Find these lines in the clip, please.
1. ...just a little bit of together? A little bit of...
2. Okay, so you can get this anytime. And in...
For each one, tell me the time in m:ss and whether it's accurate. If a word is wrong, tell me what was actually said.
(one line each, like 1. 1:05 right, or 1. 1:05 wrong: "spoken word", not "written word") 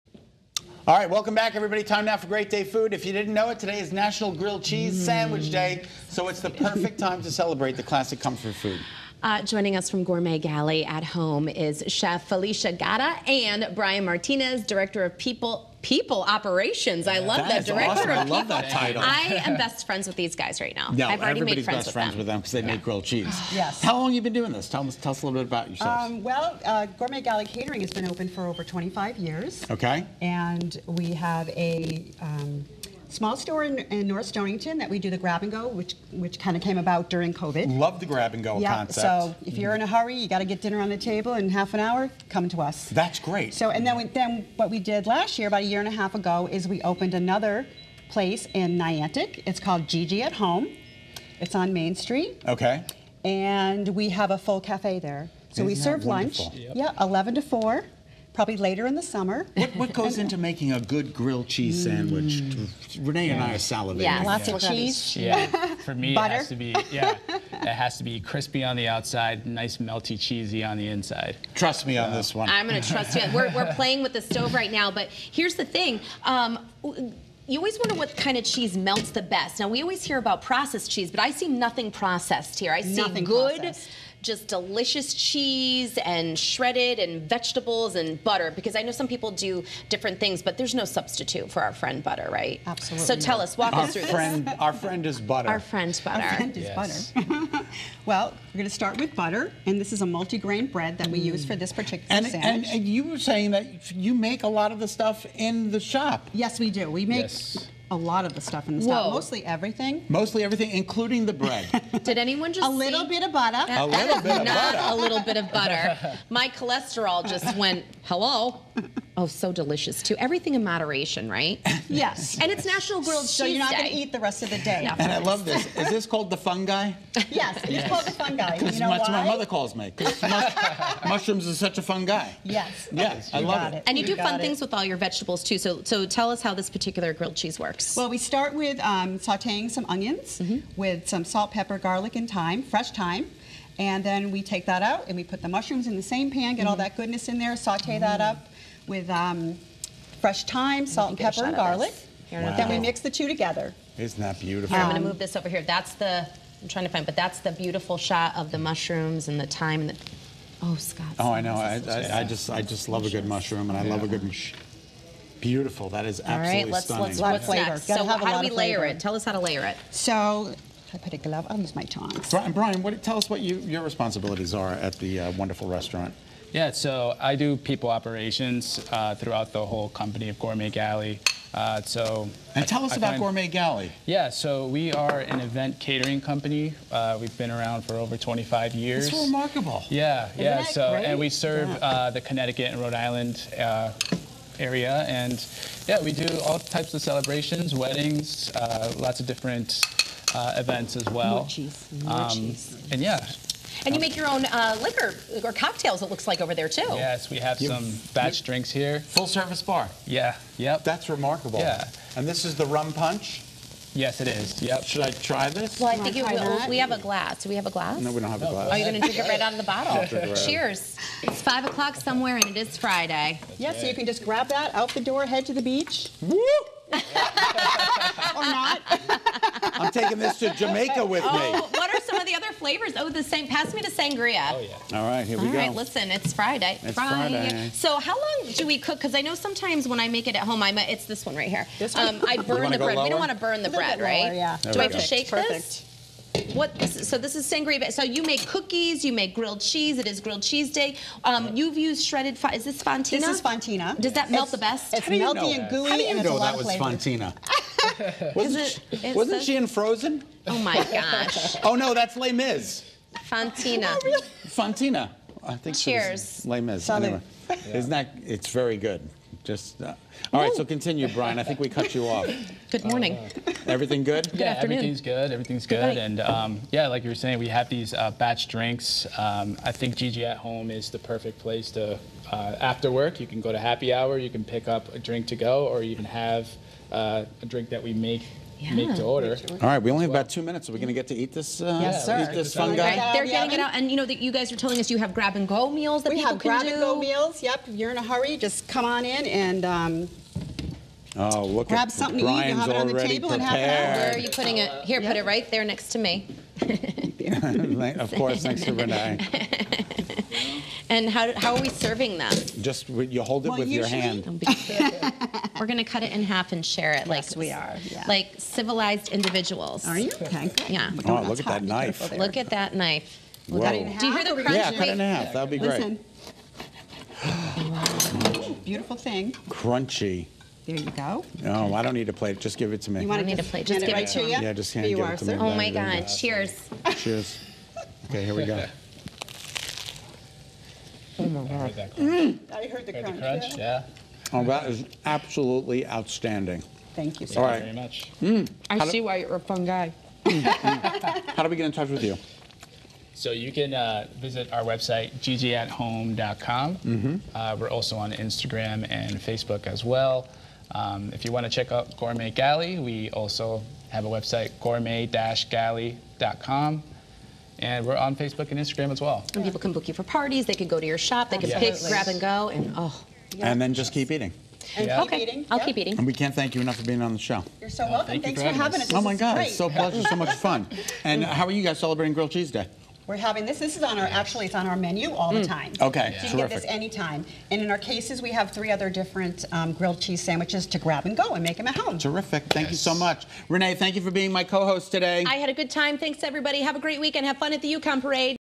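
1. 1:52 wrong: "butter", not "together"
2. 6:25 right.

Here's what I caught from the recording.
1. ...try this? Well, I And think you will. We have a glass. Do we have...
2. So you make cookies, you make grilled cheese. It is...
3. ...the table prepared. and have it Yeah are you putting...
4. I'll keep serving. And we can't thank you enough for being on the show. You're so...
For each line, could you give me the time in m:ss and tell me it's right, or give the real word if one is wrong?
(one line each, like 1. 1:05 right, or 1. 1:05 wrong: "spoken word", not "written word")
1. 3:35 wrong: "Can", not "And"
2. 4:07 right
3. 5:02 wrong: "Where", not "Yeah"
4. 6:15 wrong: "eating", not "serving".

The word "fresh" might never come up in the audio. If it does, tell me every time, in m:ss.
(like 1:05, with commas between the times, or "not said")
2:22, 2:30.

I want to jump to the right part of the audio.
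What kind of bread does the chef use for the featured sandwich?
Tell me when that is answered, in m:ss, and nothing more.
1:40.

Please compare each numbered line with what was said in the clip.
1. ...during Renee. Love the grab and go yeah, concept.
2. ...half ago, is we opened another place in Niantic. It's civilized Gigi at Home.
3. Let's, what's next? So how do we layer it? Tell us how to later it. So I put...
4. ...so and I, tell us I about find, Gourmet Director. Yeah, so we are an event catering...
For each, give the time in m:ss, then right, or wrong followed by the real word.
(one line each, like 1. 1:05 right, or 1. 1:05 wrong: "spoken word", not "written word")
1. 0:37 wrong: "COVID", not "Renee"
2. 0:45 wrong: "called", not "civilized"
3. 2:47 wrong: "layer", not "later"
4. 3:01 wrong: "Galley", not "Director".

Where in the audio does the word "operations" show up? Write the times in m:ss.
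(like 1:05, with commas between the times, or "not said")
0:16, 2:57.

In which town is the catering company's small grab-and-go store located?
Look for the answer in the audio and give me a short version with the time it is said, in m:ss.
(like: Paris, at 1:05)
North Stonington, at 0:34.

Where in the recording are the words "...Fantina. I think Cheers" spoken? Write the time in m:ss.
4:24.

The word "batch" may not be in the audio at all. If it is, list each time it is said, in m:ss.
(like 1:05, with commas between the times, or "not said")
3:28, 4:38.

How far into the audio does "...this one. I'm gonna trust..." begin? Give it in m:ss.
1:12.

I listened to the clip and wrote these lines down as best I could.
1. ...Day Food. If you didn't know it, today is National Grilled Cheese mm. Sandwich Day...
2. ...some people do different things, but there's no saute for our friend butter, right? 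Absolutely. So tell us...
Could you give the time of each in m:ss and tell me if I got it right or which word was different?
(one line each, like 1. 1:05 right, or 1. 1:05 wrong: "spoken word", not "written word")
1. 0:02 right
2. 1:28 wrong: "substitute", not "saute".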